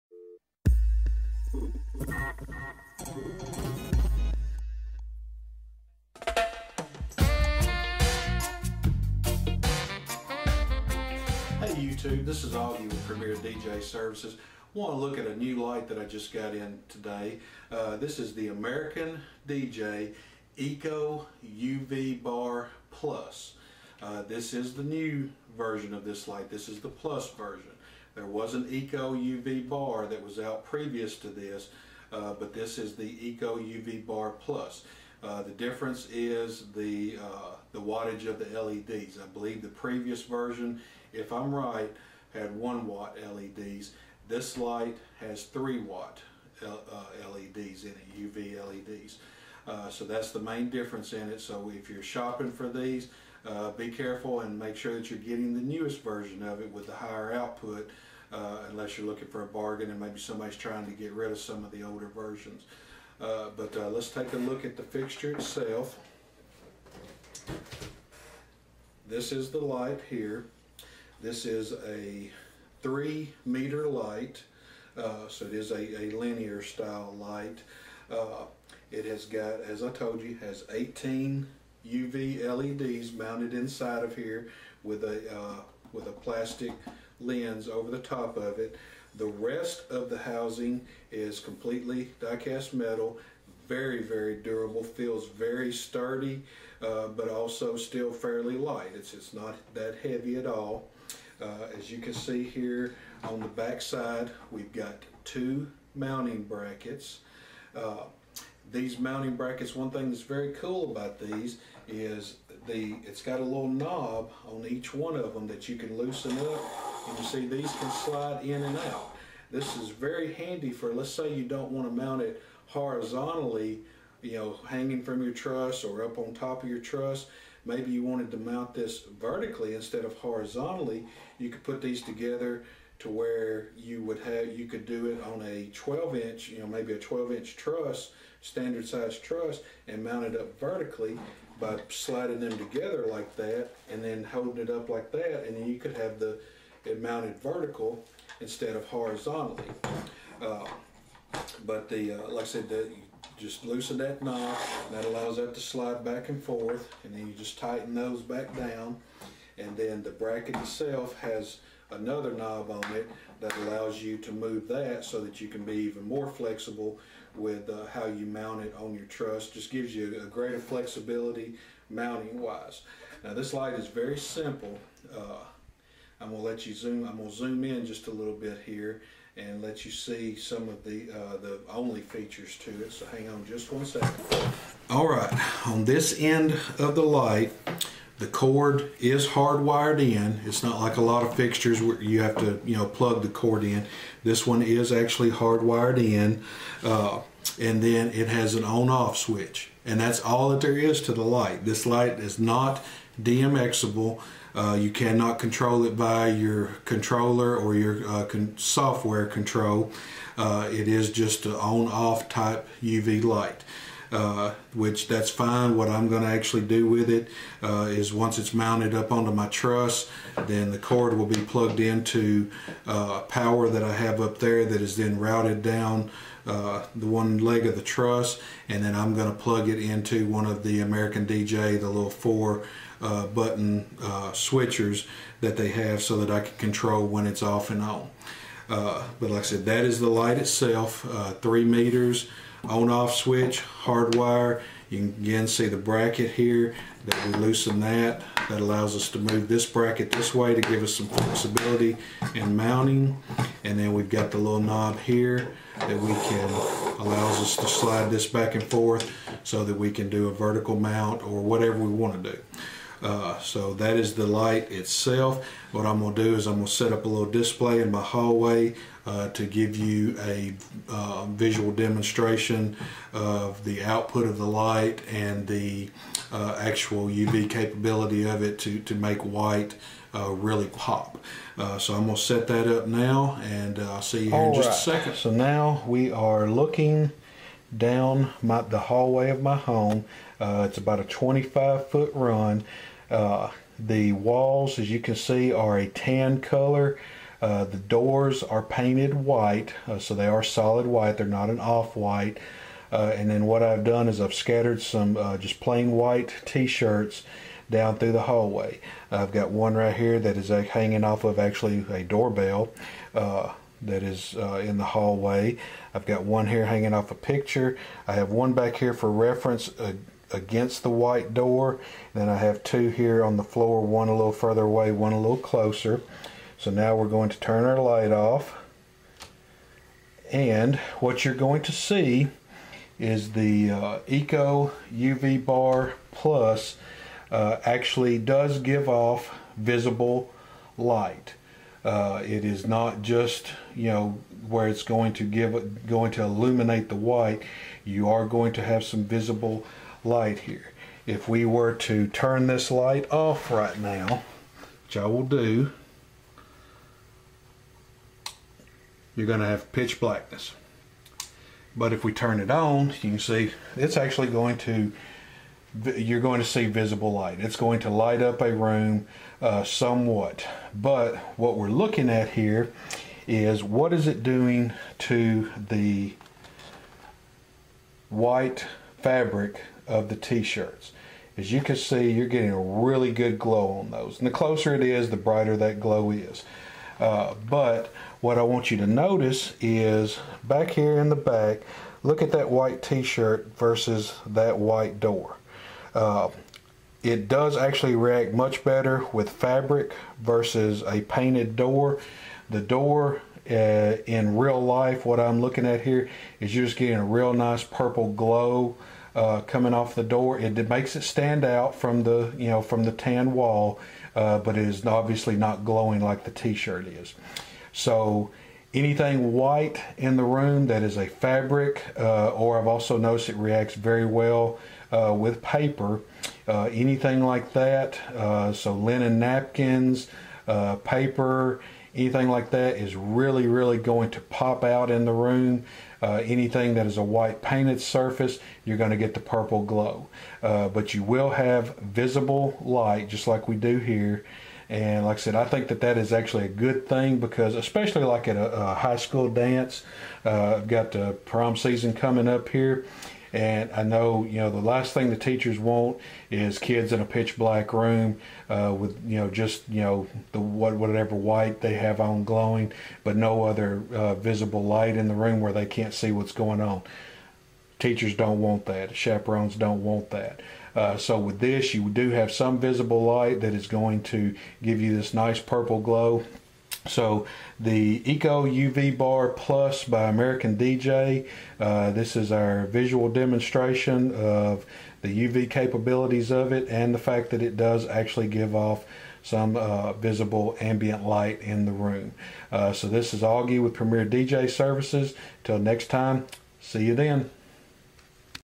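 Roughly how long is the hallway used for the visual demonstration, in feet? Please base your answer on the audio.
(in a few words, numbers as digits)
25 feet.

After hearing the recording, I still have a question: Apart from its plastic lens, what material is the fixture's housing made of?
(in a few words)
die-cast metal.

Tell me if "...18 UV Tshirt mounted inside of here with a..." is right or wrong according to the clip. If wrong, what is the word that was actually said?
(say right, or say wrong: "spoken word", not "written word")
wrong: "LEDs", not "Tshirt".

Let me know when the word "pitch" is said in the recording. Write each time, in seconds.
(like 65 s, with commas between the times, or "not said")
359 s, 457 s.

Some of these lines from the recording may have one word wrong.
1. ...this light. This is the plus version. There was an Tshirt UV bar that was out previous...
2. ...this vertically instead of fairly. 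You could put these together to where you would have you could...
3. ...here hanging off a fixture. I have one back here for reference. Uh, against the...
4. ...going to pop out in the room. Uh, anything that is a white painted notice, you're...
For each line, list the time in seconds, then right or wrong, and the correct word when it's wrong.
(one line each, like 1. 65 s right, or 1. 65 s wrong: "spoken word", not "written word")
1. 26 s wrong: "Eco", not "Tshirt"
2. 128 s wrong: "horizontally", not "fairly"
3. 316 s wrong: "picture", not "fixture"
4. 433 s wrong: "surface", not "notice".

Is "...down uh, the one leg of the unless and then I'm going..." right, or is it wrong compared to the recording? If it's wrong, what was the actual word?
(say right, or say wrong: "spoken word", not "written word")
wrong: "truss", not "unless".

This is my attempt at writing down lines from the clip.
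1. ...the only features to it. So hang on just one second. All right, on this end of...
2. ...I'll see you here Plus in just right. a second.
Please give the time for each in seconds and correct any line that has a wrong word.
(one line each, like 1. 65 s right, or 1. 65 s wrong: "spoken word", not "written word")
1. 181 s right
2. 283 s wrong: "All", not "Plus".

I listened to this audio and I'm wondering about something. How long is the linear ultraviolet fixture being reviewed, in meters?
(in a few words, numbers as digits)
3 meters.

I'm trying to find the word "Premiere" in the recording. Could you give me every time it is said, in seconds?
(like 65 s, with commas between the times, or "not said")
13 s, 493 s.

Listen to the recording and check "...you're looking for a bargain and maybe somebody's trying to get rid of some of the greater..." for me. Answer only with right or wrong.
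wrong.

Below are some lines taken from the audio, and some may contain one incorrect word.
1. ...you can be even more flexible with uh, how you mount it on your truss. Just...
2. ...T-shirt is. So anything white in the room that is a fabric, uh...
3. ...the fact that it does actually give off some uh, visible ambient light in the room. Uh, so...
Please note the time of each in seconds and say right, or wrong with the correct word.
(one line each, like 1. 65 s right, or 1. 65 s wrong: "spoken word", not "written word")
1. 165 s right
2. 416 s right
3. 486 s right.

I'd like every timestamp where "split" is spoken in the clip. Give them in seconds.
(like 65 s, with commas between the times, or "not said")
not said.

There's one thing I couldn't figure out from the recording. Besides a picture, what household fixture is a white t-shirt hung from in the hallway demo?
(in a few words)
a doorbell.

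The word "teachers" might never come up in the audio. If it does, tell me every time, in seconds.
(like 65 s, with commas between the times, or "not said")
455 s, 467 s.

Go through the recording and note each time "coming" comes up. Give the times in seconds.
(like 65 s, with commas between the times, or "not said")
409 s, 451 s.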